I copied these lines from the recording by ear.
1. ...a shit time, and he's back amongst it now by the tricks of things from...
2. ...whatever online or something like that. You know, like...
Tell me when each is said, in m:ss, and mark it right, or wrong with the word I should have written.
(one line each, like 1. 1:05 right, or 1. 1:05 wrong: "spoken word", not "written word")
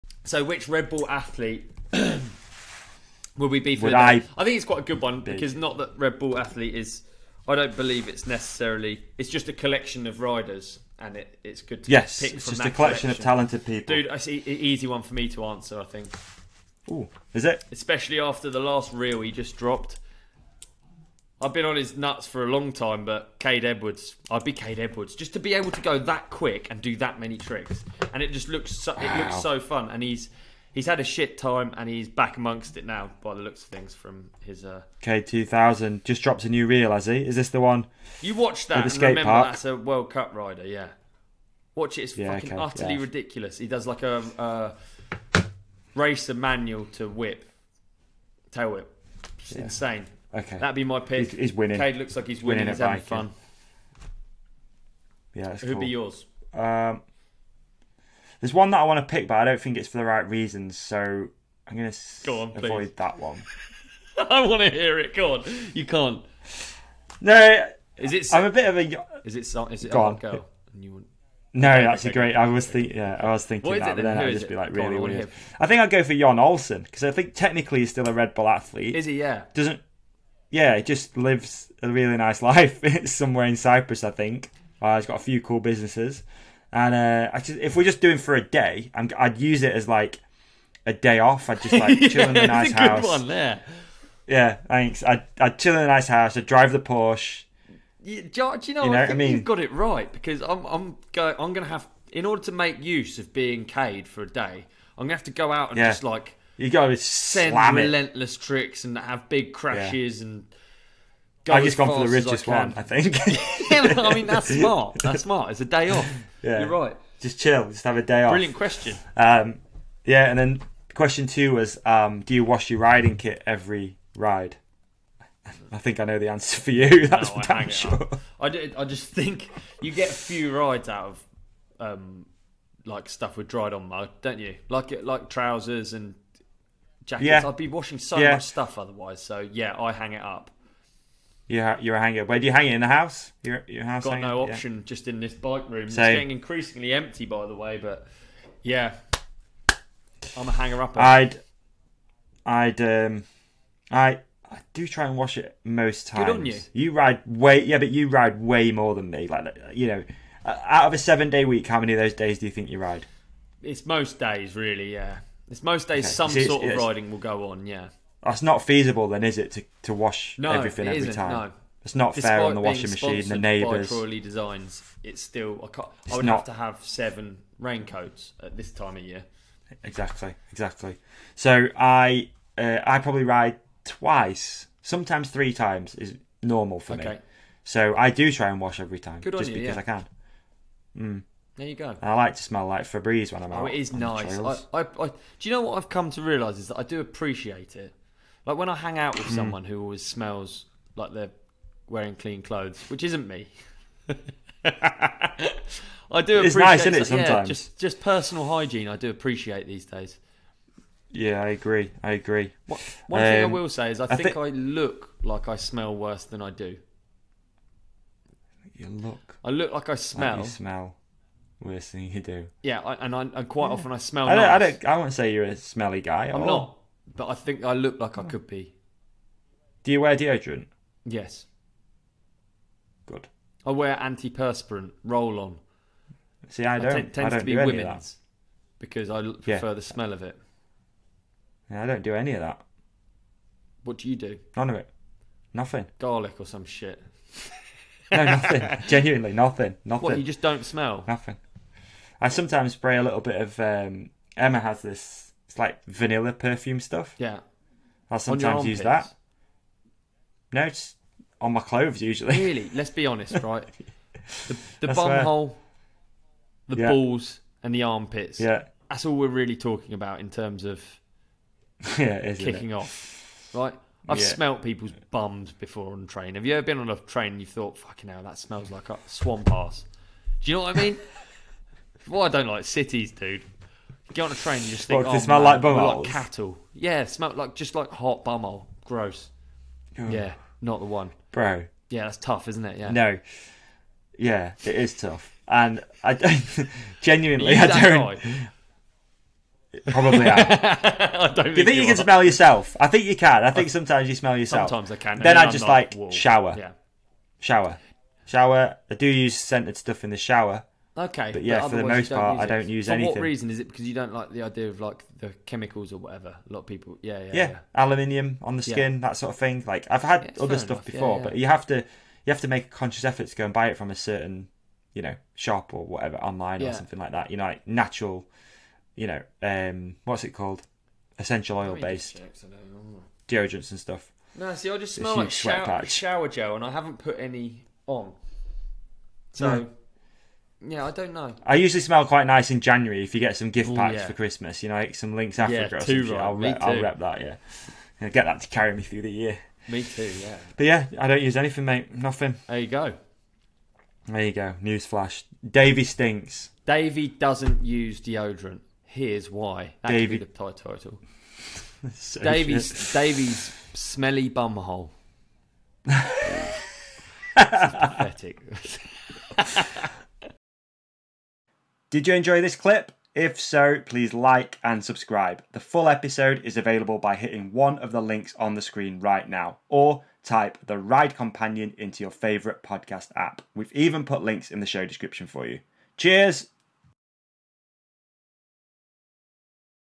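1. 0:30 wrong: "looks", not "tricks"
2. 5:25 right.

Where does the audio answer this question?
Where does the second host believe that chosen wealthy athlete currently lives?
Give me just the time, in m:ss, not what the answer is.
1:23.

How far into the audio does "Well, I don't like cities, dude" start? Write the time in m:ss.
4:42.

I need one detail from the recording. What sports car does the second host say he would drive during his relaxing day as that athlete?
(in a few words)
Porsche.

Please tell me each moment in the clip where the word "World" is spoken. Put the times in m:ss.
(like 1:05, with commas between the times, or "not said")
0:39.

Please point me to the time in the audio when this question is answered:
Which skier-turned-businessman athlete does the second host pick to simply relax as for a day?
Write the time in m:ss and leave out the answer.
1:16.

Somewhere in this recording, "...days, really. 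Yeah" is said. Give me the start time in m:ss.
2:44.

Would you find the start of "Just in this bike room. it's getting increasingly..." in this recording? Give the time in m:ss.
2:24.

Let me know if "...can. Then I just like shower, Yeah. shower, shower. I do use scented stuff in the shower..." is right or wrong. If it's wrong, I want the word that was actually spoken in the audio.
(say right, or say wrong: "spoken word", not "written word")
right.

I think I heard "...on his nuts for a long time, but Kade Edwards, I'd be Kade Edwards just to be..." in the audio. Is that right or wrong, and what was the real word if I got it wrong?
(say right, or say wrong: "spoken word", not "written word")
right.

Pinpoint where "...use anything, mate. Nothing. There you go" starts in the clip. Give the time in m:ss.
5:51.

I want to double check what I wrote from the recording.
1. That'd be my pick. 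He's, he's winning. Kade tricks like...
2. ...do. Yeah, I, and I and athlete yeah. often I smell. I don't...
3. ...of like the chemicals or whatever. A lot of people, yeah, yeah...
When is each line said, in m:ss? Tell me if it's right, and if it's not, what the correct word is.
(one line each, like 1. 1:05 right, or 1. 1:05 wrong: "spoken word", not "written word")
1. 0:50 wrong: "looks", not "tricks"
2. 3:42 wrong: "quite", not "athlete"
3. 5:14 right.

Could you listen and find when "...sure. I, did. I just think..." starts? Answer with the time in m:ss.
2:07.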